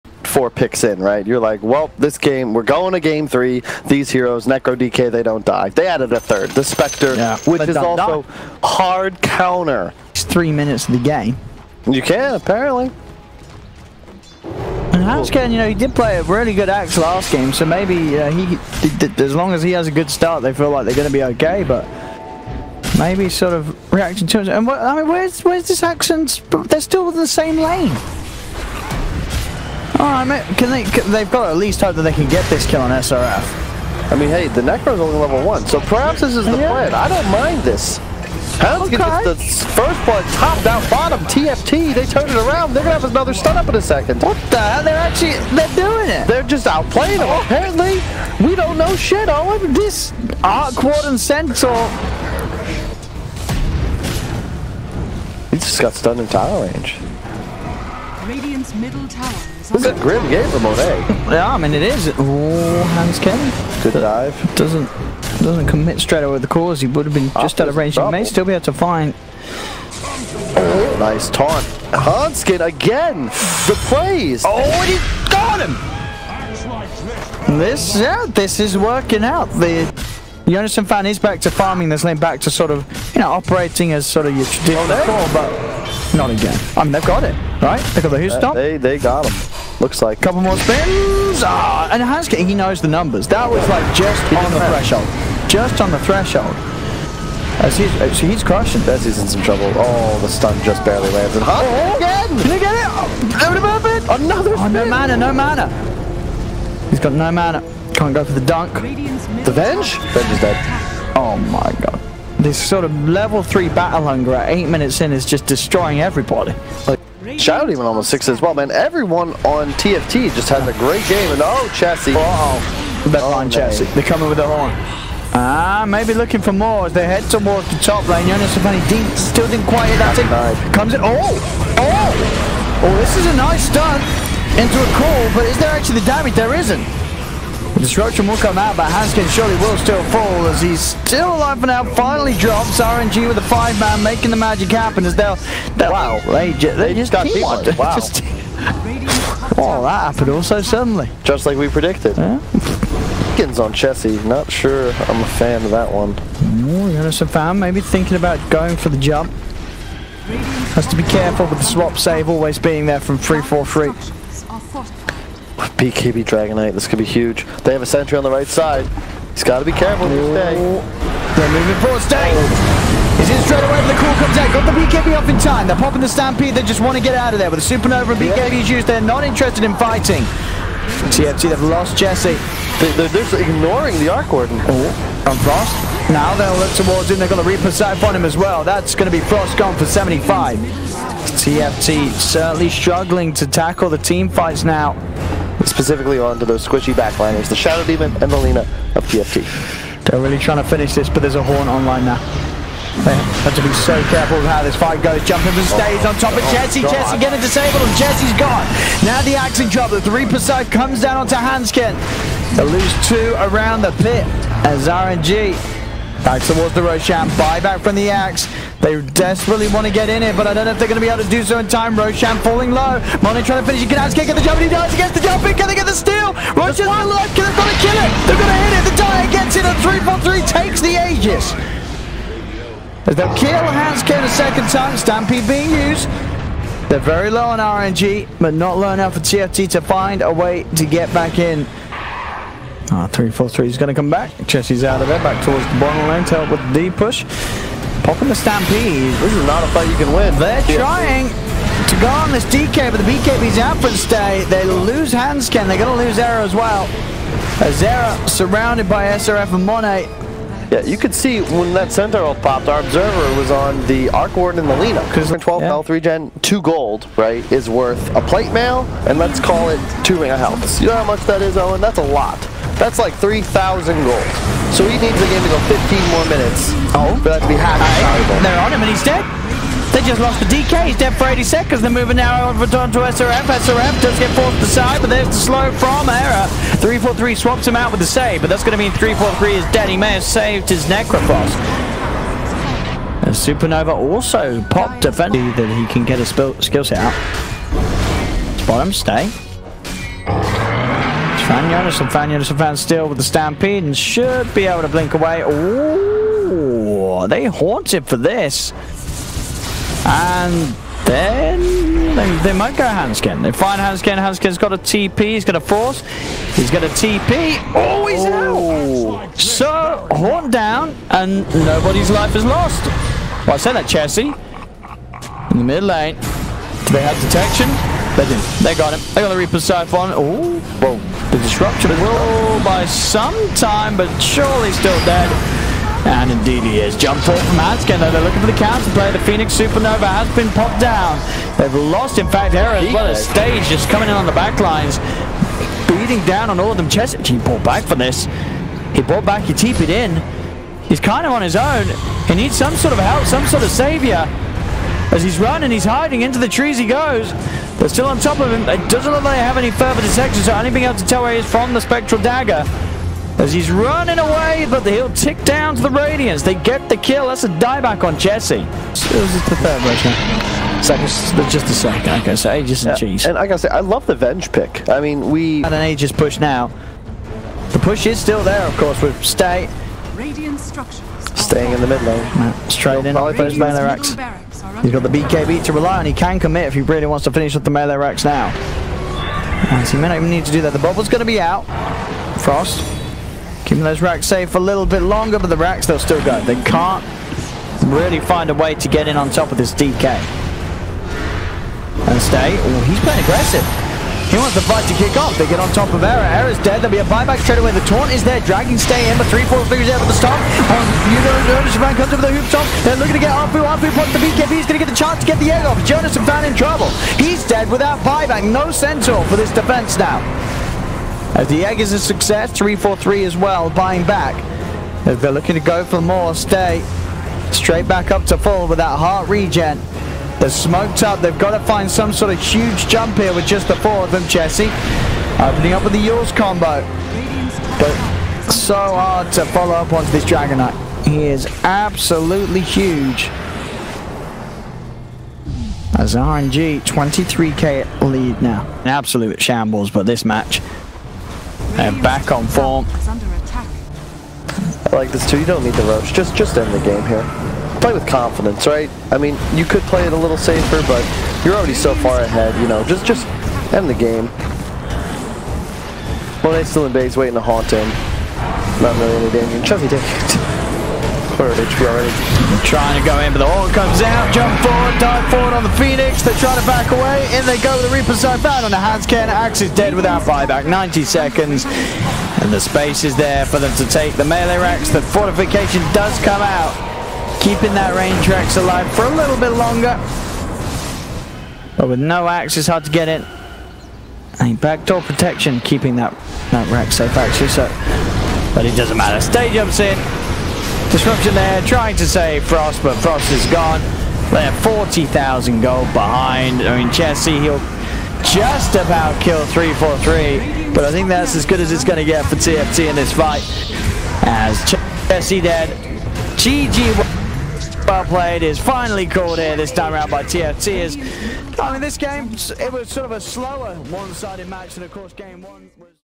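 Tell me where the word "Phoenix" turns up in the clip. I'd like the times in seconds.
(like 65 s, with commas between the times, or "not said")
339 s, 475 s.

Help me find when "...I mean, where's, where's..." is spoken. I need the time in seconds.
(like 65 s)
24 s.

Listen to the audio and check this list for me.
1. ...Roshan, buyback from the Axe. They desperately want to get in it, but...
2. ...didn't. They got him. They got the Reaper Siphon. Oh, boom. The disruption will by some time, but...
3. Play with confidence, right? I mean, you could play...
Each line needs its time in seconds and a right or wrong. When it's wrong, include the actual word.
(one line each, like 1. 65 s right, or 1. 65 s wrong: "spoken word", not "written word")
1. 216 s right
2. 328 s right
3. 457 s right.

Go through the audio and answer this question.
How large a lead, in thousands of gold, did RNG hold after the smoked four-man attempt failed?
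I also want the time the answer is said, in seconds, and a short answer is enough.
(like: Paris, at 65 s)
23k, at 446 s.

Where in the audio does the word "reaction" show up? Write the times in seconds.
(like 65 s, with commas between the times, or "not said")
23 s.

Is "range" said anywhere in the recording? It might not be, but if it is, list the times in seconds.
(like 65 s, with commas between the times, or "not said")
56 s, 67 s, 487 s.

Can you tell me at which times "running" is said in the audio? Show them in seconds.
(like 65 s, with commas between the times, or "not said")
355 s, 363 s.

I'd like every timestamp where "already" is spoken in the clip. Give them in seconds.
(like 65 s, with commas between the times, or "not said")
461 s, 471 s.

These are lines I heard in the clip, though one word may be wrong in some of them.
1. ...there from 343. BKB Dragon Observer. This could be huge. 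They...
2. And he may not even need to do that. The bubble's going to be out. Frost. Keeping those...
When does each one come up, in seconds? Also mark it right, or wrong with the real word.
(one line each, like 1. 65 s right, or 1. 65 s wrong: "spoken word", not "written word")
1. 162 s wrong: "Knight", not "Observer"
2. 389 s right.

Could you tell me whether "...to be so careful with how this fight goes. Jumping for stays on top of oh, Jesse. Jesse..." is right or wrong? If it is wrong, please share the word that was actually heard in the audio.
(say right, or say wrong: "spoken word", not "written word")
right.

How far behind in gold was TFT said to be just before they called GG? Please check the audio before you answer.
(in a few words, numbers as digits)
40,000.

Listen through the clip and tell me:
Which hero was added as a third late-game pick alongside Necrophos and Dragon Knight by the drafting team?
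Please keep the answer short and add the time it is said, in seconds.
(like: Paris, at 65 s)
Spectre, at 6 s.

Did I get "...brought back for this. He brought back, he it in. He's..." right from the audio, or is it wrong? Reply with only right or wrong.
right.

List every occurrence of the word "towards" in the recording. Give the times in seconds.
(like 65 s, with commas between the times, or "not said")
127 s, 186 s, 216 s, 245 s.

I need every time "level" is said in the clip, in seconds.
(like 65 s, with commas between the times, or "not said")
35 s, 113 s.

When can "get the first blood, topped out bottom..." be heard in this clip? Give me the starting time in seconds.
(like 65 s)
38 s.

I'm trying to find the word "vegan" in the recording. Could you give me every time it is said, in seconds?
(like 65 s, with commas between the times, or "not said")
not said.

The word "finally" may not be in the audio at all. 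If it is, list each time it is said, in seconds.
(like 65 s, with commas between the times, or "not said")
141 s, 518 s.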